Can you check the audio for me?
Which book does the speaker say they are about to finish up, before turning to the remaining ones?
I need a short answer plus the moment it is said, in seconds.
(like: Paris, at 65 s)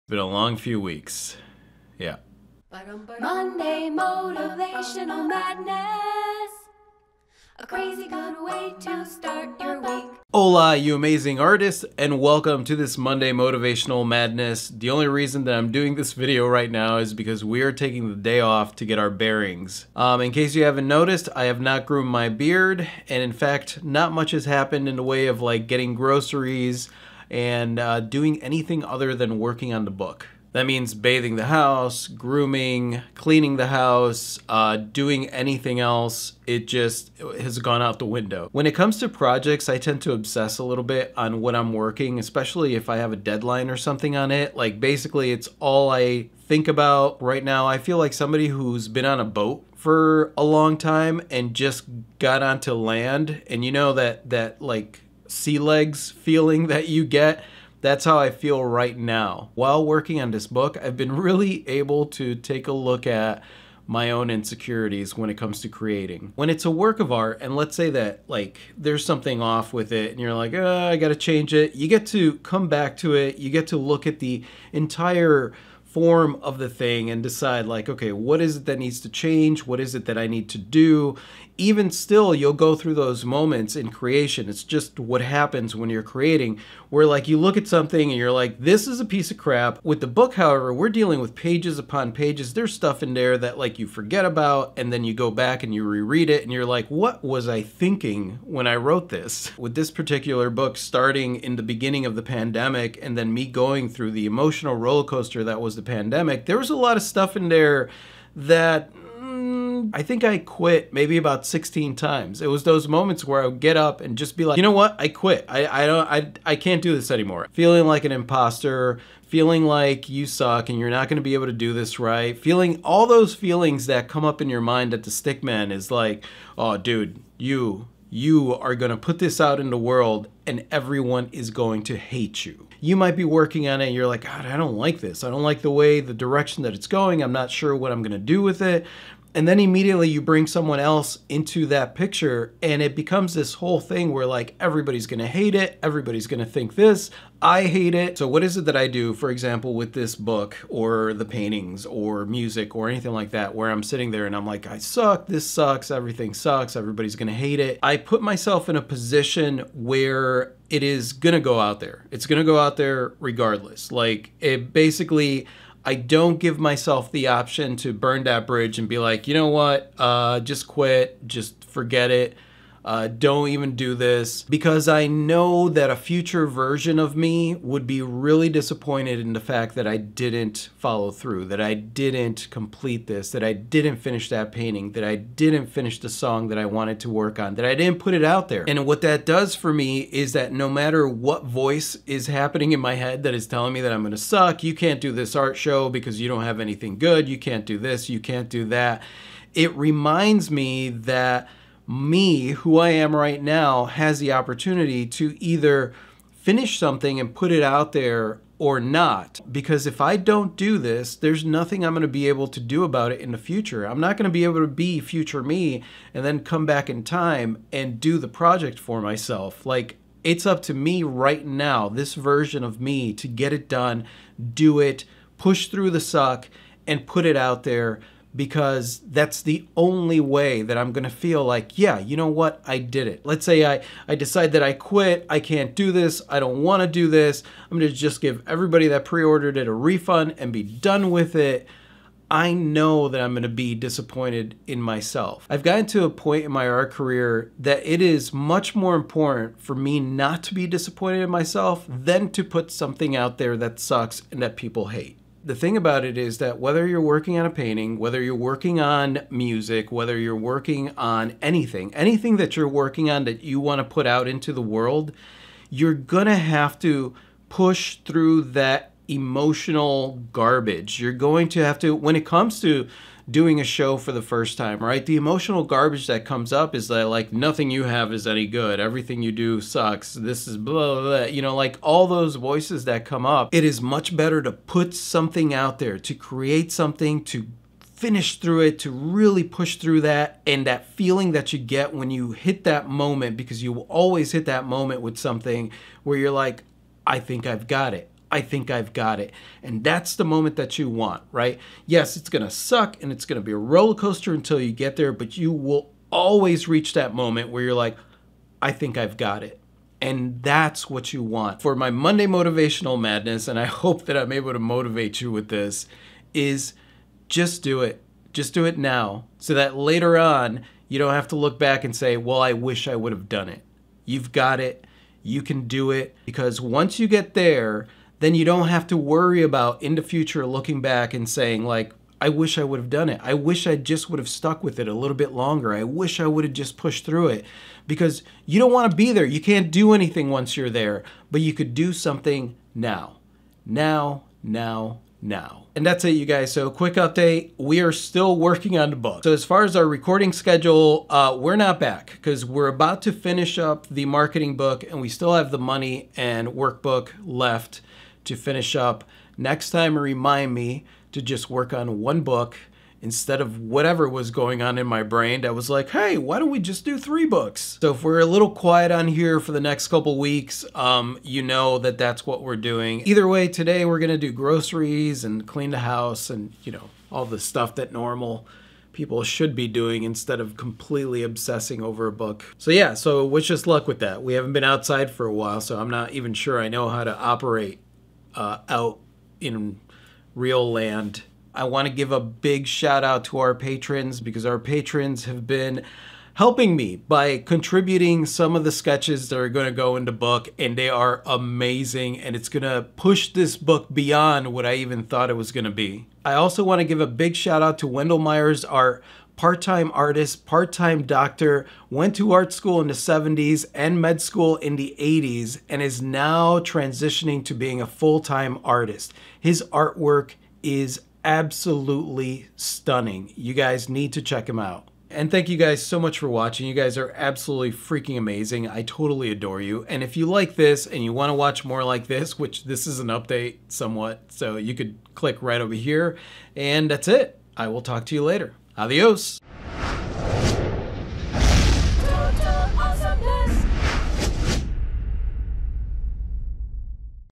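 the marketing book, at 353 s.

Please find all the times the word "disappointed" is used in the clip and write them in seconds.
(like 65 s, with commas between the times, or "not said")
178 s, 243 s, 250 s.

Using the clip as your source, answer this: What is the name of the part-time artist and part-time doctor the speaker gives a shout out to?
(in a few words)
Wendell Myers.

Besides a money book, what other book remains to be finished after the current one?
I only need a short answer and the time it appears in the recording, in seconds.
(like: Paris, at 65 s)
workbook, at 356 s.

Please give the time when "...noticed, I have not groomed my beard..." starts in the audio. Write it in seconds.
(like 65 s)
20 s.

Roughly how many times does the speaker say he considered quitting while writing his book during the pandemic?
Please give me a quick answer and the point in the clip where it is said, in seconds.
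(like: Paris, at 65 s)
16, at 111 s.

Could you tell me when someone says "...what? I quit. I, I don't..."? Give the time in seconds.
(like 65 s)
114 s.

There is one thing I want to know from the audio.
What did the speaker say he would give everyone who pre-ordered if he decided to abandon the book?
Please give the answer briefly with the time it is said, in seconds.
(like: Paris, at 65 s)
a refund, at 239 s.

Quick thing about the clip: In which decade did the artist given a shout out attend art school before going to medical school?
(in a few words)
the 70s.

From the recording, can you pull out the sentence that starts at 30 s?
That means bathing the house, grooming, cleaning the house, uh, doing anything else.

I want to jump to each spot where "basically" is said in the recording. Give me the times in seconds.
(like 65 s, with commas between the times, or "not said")
44 s, 164 s.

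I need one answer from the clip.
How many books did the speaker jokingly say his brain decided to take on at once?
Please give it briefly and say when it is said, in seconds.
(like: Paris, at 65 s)
3, at 366 s.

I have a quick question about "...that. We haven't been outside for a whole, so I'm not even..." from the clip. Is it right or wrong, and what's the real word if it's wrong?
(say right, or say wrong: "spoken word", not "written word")
wrong: "while", not "whole".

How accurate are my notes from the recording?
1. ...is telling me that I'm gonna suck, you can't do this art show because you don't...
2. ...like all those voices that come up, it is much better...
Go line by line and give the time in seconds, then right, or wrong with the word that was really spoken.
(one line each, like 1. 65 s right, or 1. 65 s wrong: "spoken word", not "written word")
1. 193 s right
2. 281 s right.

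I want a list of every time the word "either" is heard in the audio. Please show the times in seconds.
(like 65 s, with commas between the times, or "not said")
205 s, 373 s.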